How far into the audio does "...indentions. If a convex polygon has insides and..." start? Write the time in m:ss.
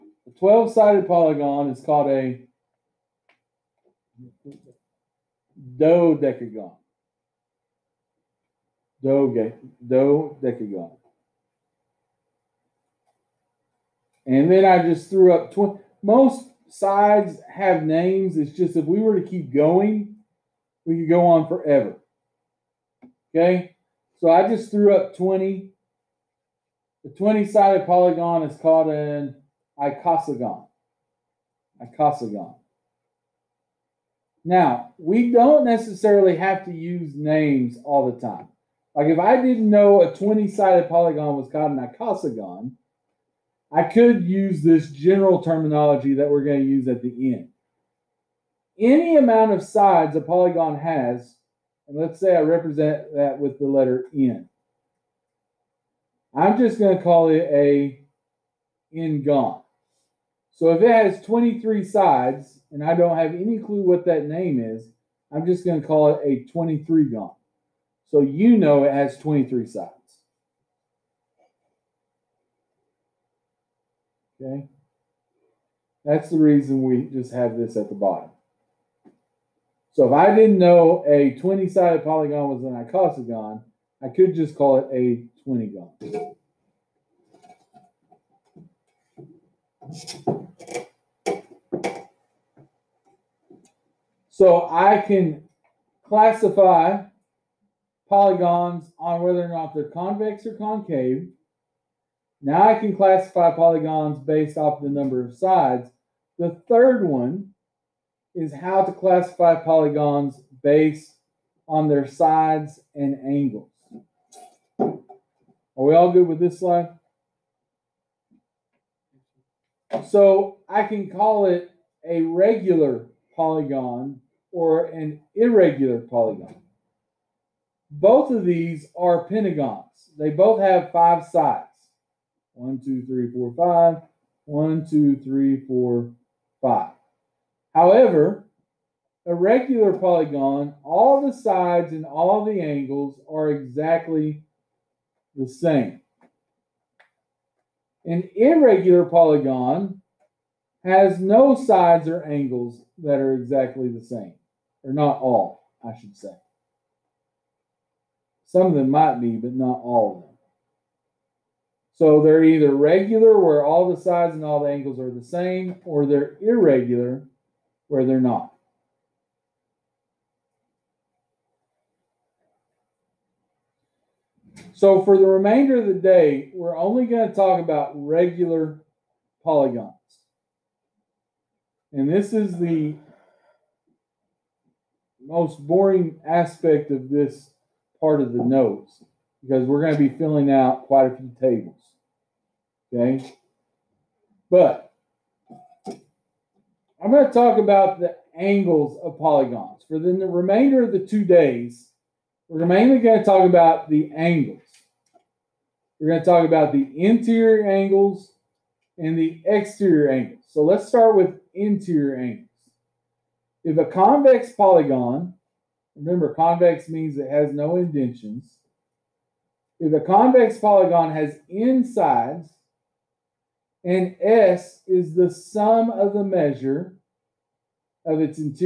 3:37.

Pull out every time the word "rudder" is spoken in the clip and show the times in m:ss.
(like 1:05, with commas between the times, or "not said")
not said.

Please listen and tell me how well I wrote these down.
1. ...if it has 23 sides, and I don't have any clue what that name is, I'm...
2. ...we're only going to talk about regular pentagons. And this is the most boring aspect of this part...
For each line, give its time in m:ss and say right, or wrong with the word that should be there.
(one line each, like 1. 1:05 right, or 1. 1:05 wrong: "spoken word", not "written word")
1. 1:00 right
2. 2:56 wrong: "polygons", not "pentagons".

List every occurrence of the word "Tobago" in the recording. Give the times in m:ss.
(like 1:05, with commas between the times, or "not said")
not said.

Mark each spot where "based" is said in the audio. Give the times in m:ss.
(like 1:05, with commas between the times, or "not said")
1:44, 1:50.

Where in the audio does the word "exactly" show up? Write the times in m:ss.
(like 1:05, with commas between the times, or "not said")
2:23, 2:33.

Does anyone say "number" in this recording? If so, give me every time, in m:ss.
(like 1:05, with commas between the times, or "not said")
1:44.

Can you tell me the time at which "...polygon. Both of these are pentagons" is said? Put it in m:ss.
2:05.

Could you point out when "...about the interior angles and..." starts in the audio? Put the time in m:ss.
3:26.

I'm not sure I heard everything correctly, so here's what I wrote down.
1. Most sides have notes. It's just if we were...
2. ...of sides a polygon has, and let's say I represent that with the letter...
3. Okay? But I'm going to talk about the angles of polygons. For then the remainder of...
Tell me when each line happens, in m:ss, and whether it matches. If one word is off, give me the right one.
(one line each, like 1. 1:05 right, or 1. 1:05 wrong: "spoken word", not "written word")
1. 0:16 wrong: "names", not "notes"
2. 0:49 right
3. 3:12 right.